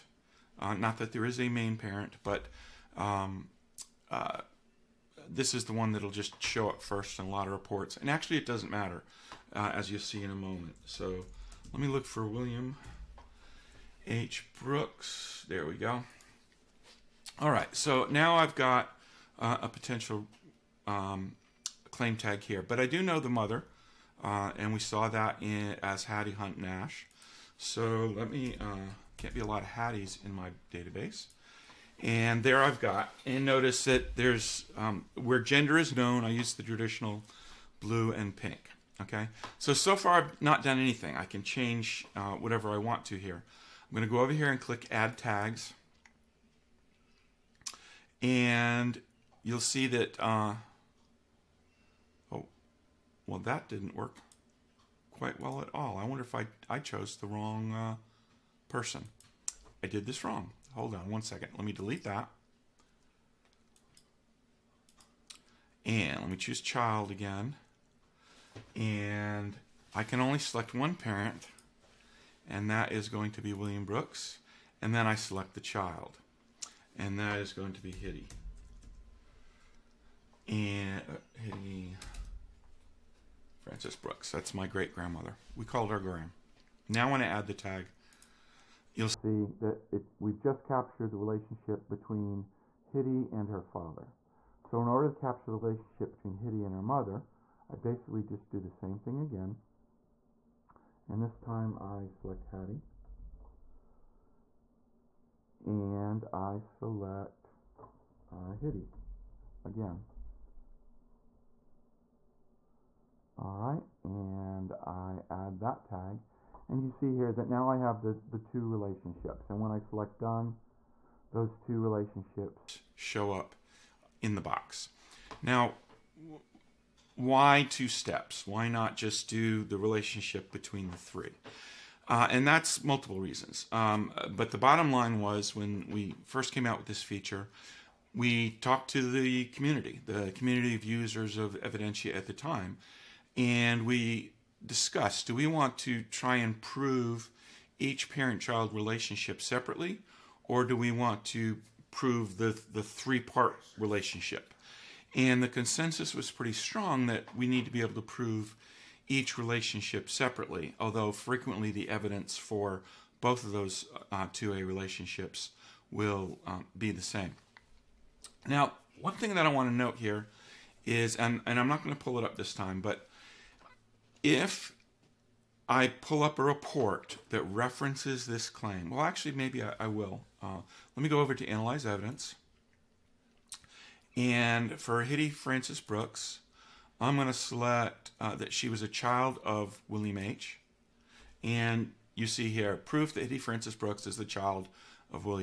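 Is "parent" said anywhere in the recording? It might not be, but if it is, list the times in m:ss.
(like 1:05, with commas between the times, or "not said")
0:01, 1:10, 2:28.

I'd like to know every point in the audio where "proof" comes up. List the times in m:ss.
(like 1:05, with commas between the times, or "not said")
3:12.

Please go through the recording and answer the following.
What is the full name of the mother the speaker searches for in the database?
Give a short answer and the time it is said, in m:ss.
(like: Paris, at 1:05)
Hattie Hunt Nash, at 0:26.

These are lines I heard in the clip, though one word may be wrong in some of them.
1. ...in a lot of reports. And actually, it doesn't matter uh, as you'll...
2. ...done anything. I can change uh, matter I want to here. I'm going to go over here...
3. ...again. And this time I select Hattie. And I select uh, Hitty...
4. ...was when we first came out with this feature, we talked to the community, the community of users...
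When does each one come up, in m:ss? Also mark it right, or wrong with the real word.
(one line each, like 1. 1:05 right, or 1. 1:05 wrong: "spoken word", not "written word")
1. 0:07 right
2. 0:40 wrong: "whatever", not "matter"
3. 1:39 right
4. 2:15 right.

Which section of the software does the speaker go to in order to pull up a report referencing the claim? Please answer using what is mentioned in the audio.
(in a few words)
Analyze Evidence.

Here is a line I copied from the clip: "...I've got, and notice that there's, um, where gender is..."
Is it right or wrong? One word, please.
right.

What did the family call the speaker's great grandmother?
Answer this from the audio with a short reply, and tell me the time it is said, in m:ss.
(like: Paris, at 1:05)
Graham, at 1:25.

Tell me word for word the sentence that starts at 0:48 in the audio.
And you'll see that, uh, oh, well, that didn't work quite well at all.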